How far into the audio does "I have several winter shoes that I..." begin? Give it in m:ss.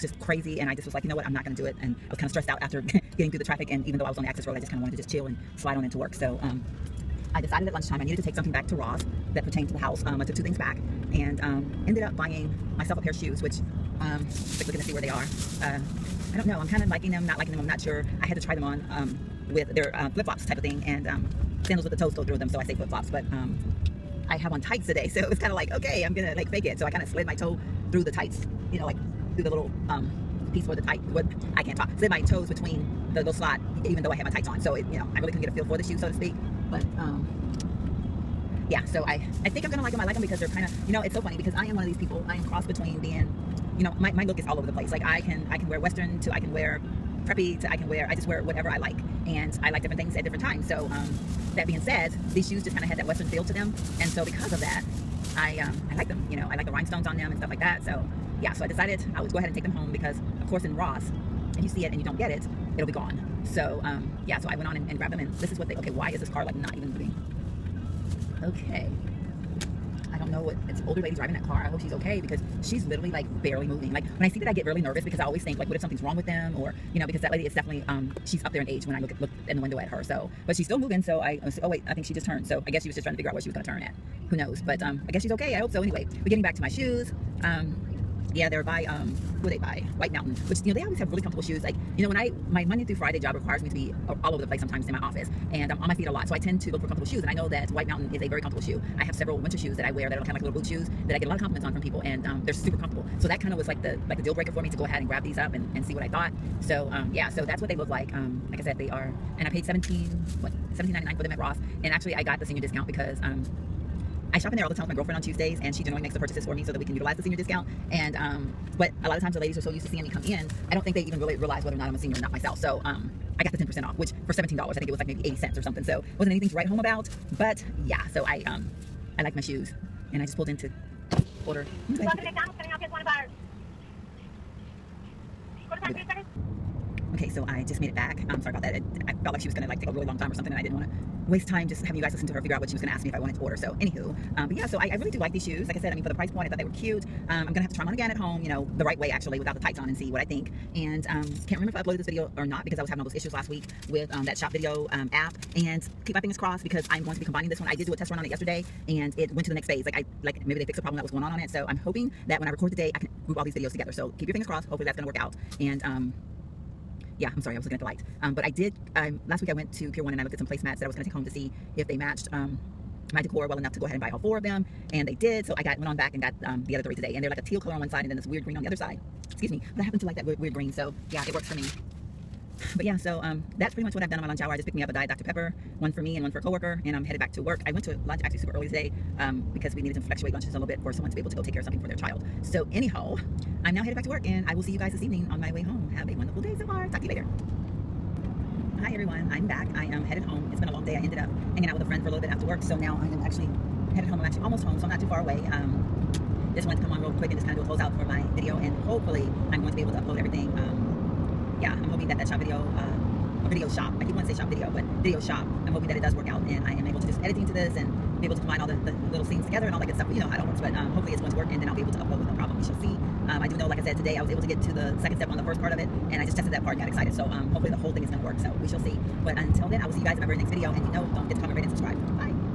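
1:38.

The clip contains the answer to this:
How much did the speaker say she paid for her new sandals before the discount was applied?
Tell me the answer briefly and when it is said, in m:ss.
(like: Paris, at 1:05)
$17.99, at 1:50.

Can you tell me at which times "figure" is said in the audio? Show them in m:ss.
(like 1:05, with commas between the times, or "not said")
1:23, 2:22.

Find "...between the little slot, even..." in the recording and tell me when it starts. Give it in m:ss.
0:32.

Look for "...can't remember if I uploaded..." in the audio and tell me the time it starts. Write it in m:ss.
2:31.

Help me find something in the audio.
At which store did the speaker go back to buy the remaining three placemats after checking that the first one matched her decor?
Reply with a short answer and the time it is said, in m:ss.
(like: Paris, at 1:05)
Pier One, at 2:49.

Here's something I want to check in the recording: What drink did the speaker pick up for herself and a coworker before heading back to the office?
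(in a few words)
Diet Dr. Pepper.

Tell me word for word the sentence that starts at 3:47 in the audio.
So um, hopefully the whole thing is going to work.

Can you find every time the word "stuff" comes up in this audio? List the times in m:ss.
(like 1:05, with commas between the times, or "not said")
0:57, 3:39.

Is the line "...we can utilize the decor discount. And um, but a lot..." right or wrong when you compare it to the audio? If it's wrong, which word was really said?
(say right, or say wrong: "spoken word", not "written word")
wrong: "senior", not "decor".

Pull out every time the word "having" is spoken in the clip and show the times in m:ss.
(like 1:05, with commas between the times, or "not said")
2:21, 2:32.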